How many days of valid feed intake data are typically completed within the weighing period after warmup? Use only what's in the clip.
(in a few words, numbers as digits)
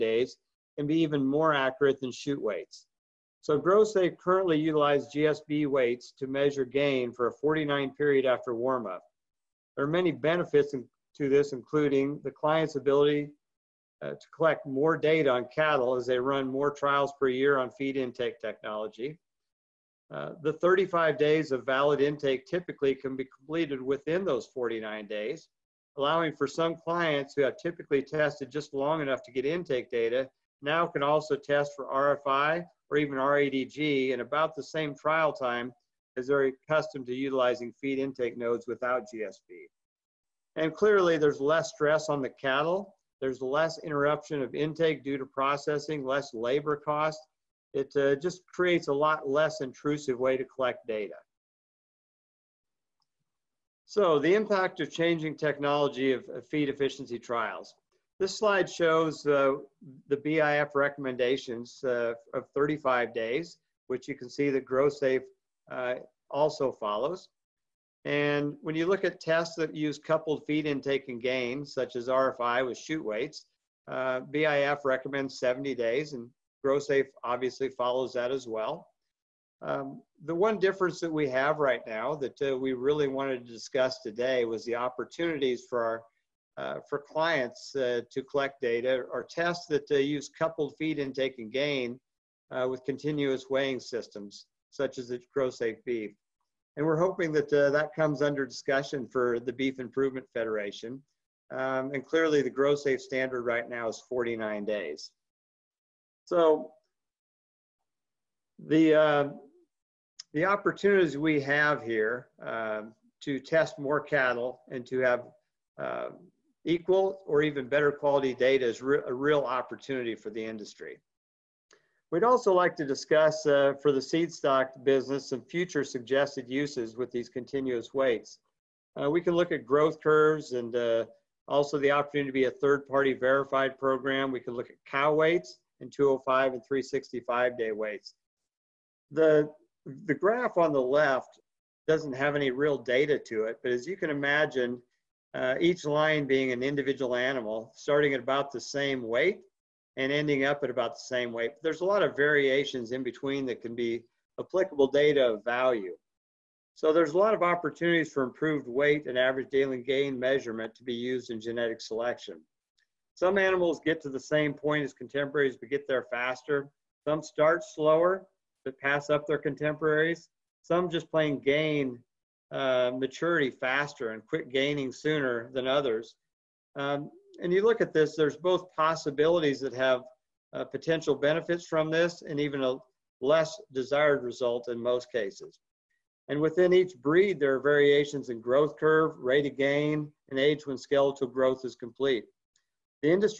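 35.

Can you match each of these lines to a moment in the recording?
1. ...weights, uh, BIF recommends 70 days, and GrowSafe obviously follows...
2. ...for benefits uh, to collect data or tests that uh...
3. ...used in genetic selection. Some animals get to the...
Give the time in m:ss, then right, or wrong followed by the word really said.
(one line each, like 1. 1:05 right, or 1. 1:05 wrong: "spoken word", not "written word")
1. 1:13 right
2. 1:26 wrong: "clients", not "benefits"
3. 2:40 right.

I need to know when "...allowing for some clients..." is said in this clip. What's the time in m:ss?
0:25.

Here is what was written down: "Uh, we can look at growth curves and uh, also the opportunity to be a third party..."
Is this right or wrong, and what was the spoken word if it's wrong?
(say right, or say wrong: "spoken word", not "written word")
right.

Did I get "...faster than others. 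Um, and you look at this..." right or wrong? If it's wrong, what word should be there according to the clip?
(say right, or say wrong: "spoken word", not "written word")
wrong: "sooner", not "faster".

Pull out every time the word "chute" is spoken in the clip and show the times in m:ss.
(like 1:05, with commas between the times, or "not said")
0:02, 1:12.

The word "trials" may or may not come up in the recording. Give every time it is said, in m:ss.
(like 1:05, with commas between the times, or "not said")
0:16, 0:34, 0:57.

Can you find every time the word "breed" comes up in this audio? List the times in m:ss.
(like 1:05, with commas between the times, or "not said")
3:07.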